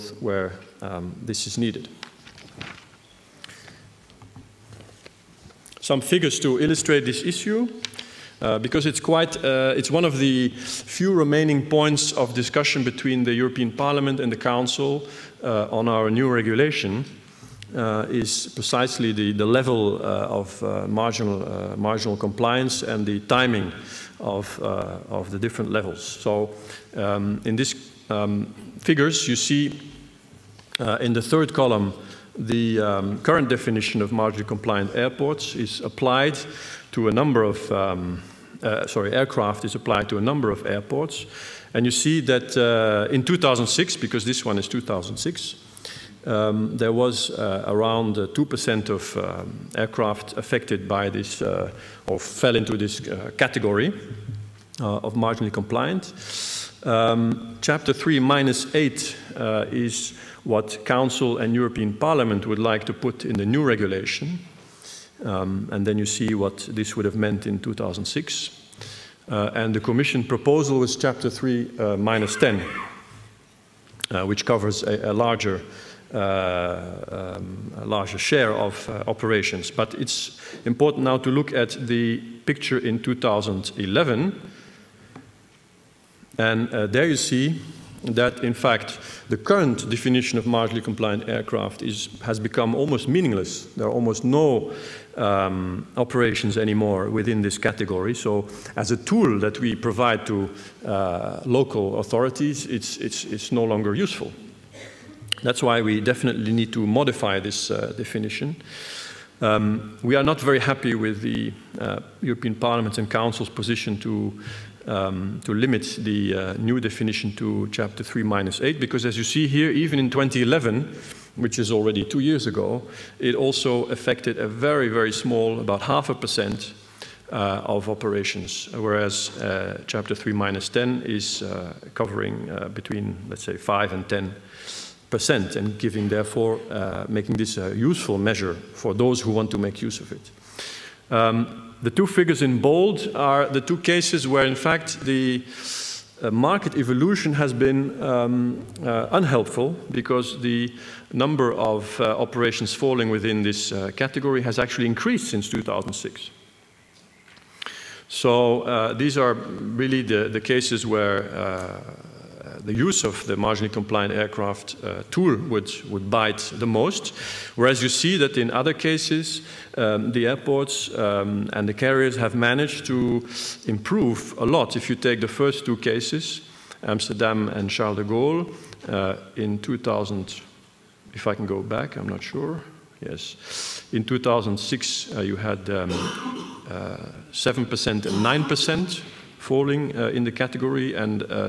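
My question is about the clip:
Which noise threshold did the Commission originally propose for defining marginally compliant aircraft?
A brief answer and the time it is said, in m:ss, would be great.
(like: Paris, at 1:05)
Chapter 3 minus 10, at 1:10.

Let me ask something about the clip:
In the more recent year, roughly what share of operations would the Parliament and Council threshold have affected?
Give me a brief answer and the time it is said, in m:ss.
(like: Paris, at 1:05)
half a percent, at 2:05.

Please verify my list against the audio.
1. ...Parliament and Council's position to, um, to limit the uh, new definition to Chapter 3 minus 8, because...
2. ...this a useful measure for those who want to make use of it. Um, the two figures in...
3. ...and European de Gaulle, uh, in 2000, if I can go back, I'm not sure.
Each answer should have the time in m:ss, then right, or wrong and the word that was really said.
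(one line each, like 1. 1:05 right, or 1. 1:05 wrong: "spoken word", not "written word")
1. 1:52 right
2. 2:17 right
3. 2:57 wrong: "Charles", not "European".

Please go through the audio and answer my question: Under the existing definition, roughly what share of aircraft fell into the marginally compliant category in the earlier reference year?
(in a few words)
2%.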